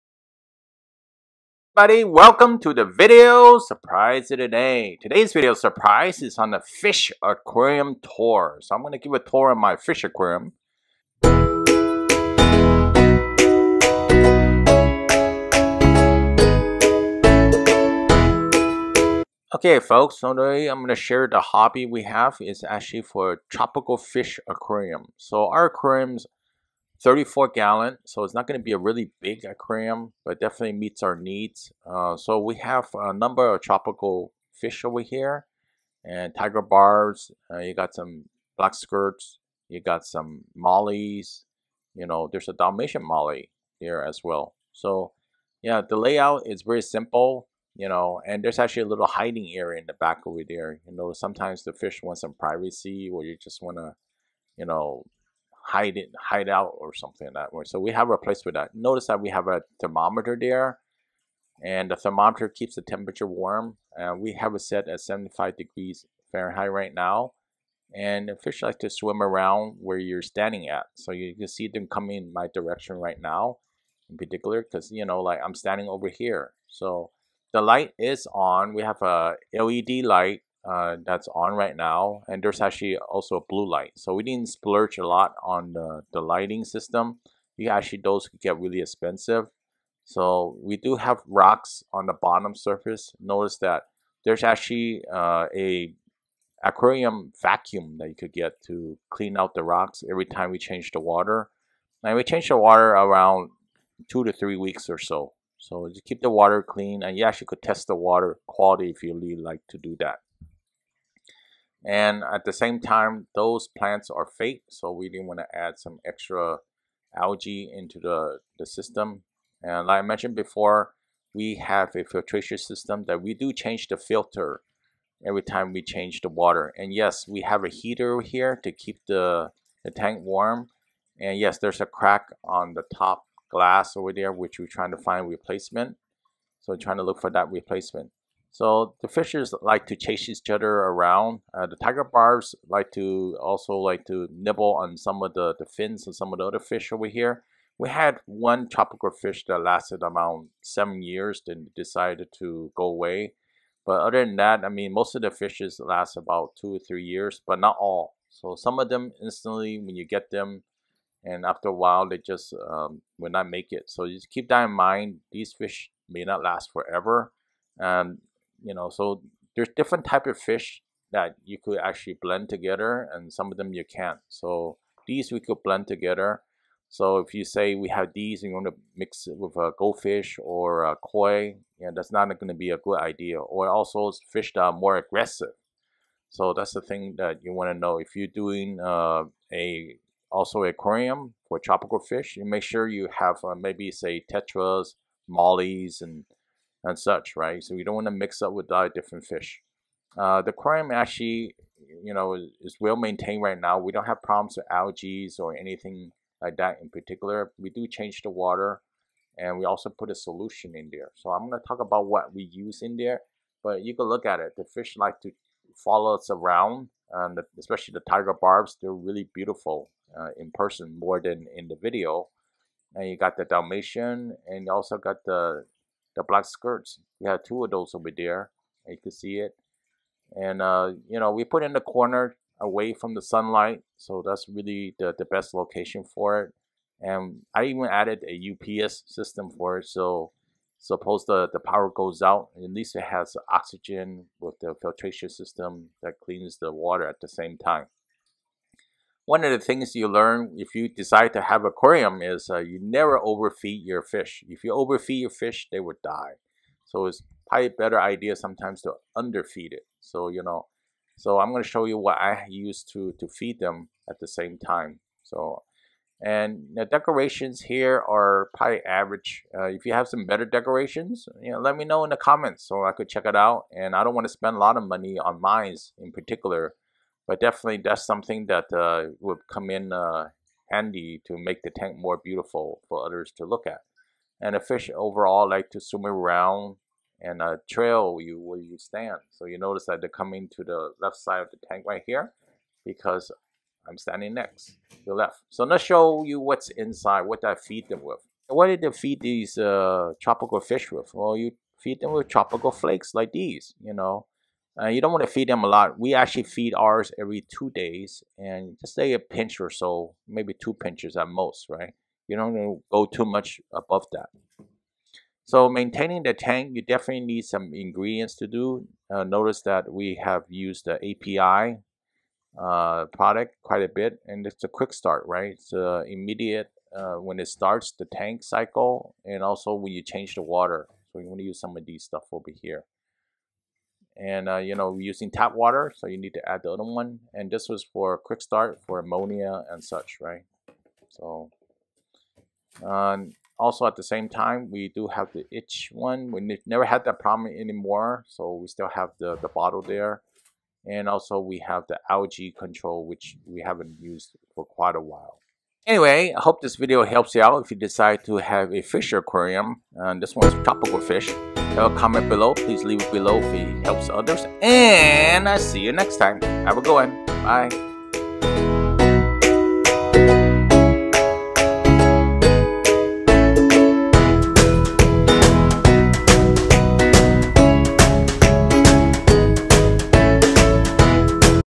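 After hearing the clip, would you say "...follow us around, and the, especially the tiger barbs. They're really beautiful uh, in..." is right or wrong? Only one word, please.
right.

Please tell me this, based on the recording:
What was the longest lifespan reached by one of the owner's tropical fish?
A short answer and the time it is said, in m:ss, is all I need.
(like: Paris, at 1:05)
7 years, at 2:30.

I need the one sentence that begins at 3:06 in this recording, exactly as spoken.
So that's the thing that you want to know.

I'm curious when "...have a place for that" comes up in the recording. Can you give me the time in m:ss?
0:57.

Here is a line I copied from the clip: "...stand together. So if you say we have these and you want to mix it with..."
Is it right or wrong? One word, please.
wrong.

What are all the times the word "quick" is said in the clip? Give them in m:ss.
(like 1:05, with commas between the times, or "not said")
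5:24, 5:38.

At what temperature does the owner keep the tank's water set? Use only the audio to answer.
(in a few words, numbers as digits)
75 degrees Fahrenheit.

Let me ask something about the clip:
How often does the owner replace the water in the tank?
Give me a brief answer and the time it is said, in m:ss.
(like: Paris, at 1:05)
2 to 3 weeks, at 1:44.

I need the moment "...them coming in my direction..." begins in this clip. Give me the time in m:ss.
1:11.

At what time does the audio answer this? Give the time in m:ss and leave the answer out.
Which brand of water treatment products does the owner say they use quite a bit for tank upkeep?
5:20.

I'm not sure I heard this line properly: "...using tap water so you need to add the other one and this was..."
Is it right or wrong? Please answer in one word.
right.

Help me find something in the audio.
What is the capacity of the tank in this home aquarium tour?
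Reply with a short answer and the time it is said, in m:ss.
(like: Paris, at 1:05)
34 gallons, at 0:27.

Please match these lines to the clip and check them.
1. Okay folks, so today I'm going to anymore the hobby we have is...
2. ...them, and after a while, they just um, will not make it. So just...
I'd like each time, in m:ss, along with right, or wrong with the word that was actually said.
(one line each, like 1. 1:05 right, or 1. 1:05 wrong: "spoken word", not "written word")
1. 0:19 wrong: "share", not "anymore"
2. 2:40 right.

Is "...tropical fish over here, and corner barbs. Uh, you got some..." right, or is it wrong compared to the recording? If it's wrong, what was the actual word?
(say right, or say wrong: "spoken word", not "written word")
wrong: "tiger", not "corner".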